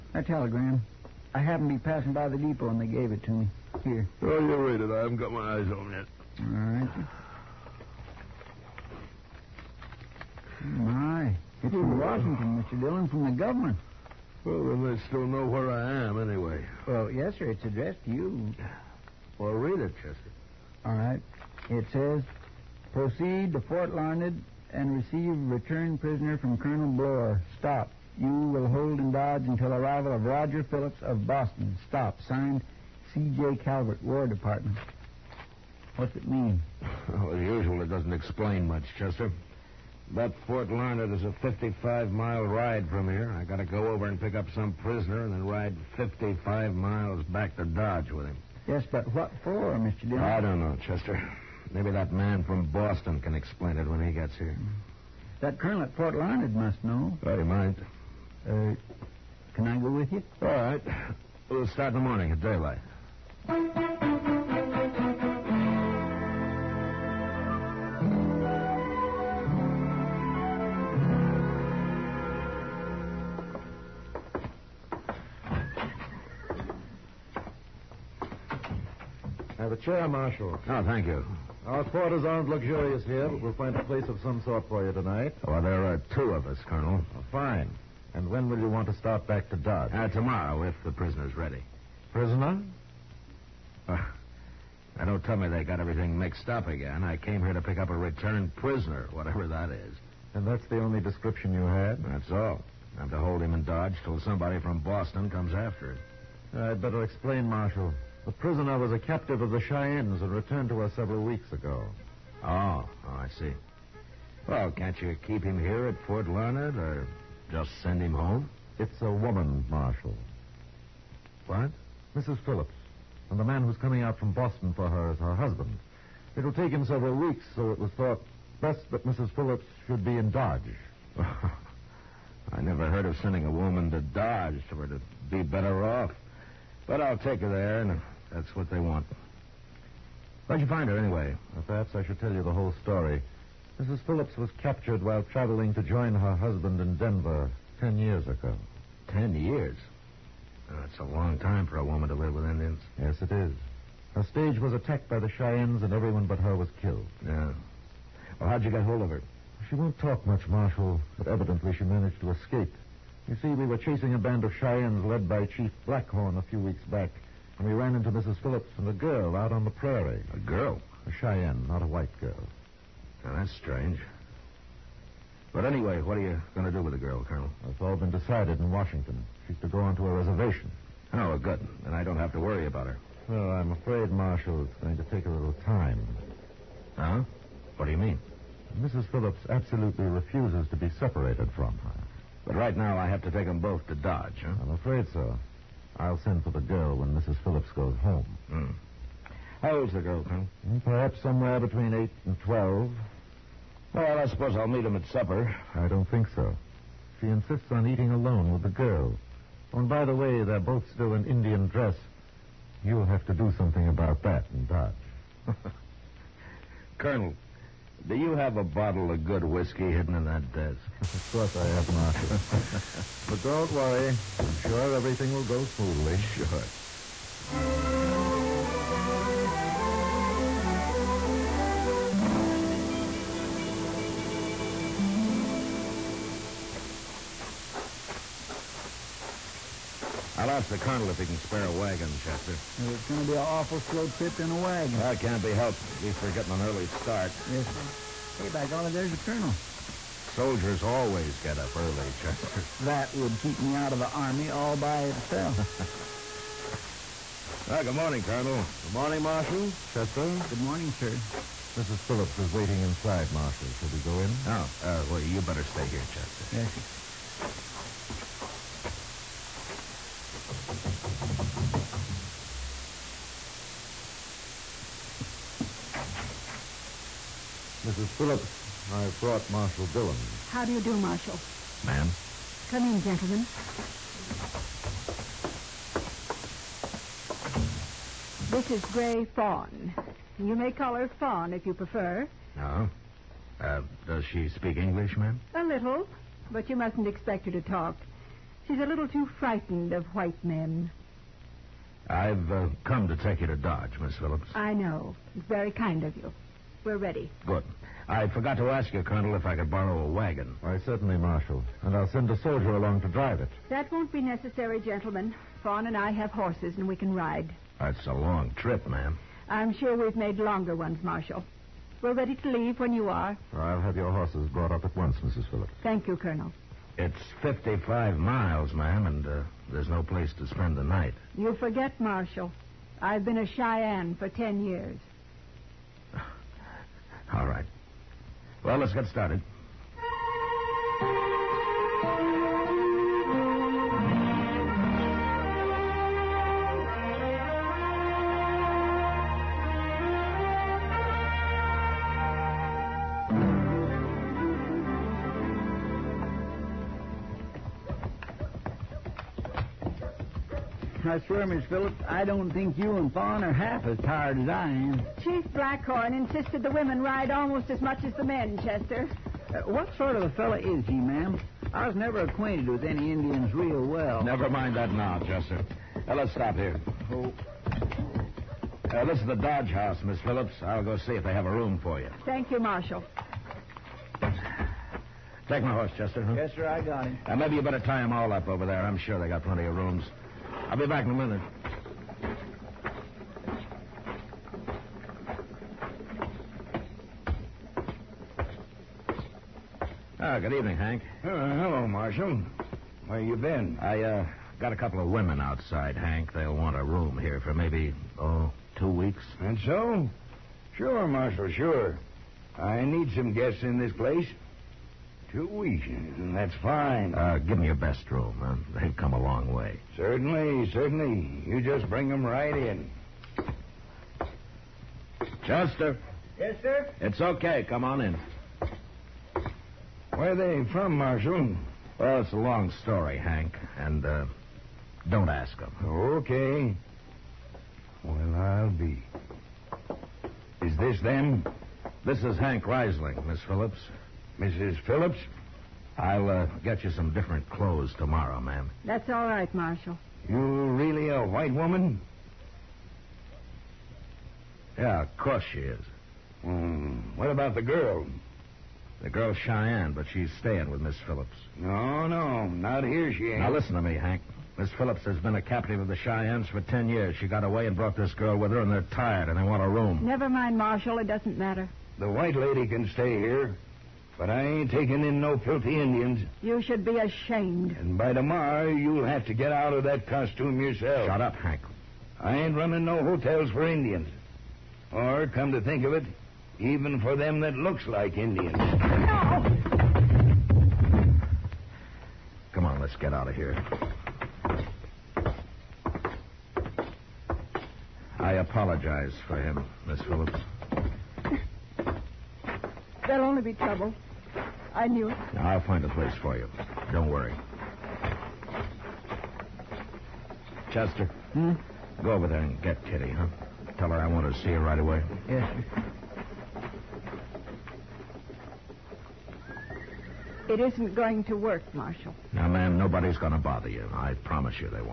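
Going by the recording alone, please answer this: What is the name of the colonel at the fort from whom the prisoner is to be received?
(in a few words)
Colonel Bloor.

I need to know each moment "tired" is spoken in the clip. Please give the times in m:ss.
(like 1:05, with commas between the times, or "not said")
6:03, 7:48.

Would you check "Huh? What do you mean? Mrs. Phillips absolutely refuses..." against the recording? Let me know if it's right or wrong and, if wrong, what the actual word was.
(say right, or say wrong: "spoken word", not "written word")
right.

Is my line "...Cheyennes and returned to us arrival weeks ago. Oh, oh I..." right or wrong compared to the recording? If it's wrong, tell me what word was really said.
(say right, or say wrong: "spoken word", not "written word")
wrong: "several", not "arrival".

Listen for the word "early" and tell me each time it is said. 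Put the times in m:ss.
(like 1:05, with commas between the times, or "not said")
4:06, 4:11.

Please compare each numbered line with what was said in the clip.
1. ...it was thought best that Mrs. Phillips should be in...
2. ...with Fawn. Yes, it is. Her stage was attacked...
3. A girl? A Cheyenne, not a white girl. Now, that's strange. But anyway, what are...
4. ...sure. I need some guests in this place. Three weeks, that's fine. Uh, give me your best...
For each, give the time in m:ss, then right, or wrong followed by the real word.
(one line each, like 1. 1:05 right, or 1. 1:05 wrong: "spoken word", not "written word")
1. 2:07 right
2. 2:32 wrong: "Indians", not "Fawn"
3. 2:50 right
4. 6:51 wrong: "Two", not "Three".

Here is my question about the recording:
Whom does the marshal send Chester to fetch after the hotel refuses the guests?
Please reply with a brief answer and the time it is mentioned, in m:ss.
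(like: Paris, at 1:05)
Kitty, at 8:32.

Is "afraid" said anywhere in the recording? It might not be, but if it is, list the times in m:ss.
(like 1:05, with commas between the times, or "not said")
3:03, 3:14.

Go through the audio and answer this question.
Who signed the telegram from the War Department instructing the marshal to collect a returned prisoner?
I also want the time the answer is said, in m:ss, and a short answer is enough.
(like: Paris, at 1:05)
C.J. Calvert, at 0:33.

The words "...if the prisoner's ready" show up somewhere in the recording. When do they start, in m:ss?
1:30.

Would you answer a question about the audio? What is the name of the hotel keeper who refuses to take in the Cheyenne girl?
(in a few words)
Hank Risling.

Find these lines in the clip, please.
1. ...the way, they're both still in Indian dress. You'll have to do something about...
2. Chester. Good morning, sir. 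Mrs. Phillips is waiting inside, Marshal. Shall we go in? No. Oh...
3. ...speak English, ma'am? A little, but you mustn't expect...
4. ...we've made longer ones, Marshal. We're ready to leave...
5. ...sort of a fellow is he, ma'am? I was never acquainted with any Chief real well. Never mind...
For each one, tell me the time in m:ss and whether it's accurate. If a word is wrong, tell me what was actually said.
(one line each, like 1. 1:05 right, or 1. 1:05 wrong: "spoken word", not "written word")
1. 3:30 right
2. 4:19 right
3. 4:54 right
4. 5:19 right
5. 6:09 wrong: "Indians", not "Chief".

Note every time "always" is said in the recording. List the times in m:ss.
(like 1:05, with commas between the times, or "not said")
4:10.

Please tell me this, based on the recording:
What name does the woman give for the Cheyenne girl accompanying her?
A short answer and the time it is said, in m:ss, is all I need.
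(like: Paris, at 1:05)
Gray Fawn, at 4:48.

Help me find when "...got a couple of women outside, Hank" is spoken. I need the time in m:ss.
6:44.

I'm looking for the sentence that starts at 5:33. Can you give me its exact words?
I've been a Cheyenne for 10 years.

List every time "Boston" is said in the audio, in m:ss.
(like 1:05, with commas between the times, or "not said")
0:31, 0:52, 1:44, 2:04.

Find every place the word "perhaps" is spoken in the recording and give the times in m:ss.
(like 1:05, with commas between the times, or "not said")
2:21, 3:20.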